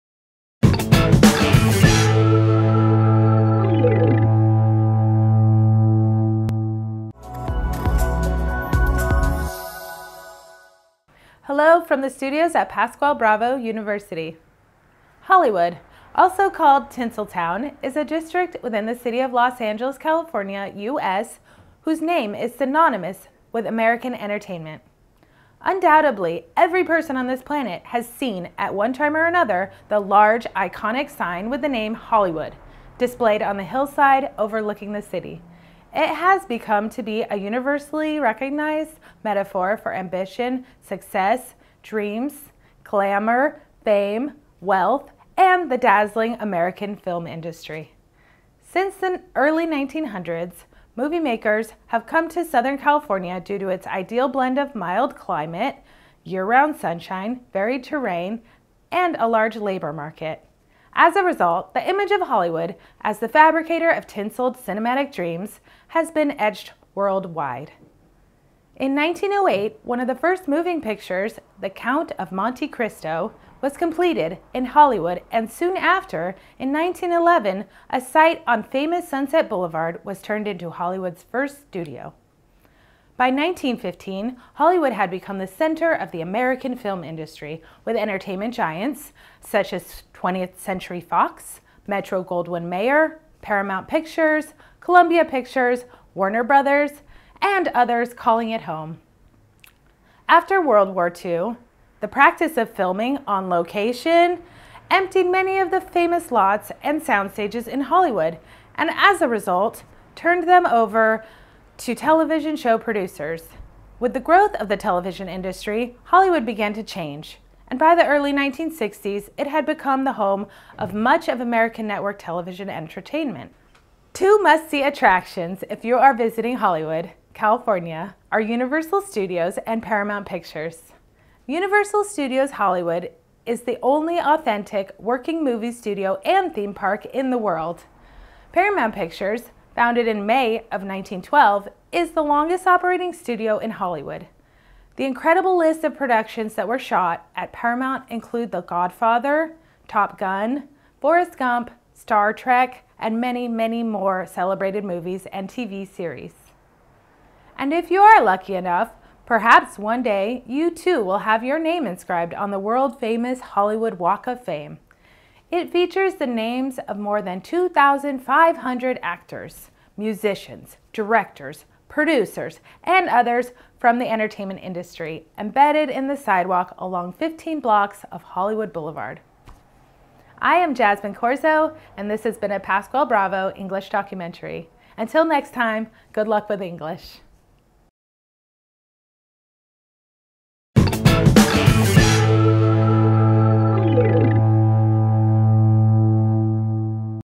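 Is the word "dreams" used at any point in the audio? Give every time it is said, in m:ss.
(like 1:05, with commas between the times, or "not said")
0:41, 1:05.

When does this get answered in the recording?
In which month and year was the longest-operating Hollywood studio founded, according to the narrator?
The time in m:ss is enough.
2:20.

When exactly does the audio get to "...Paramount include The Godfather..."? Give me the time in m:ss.
2:27.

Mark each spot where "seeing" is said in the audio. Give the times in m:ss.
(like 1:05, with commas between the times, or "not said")
not said.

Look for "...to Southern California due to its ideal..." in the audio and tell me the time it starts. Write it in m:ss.
0:52.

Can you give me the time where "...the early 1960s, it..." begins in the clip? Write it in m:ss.
1:57.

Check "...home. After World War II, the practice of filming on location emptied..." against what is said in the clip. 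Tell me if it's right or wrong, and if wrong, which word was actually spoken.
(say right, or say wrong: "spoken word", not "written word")
right.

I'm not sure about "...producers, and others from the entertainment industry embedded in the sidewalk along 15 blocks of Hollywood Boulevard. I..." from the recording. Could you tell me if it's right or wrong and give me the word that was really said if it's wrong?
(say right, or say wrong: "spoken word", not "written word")
right.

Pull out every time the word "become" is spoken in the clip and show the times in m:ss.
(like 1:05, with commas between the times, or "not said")
0:36, 1:25, 1:59.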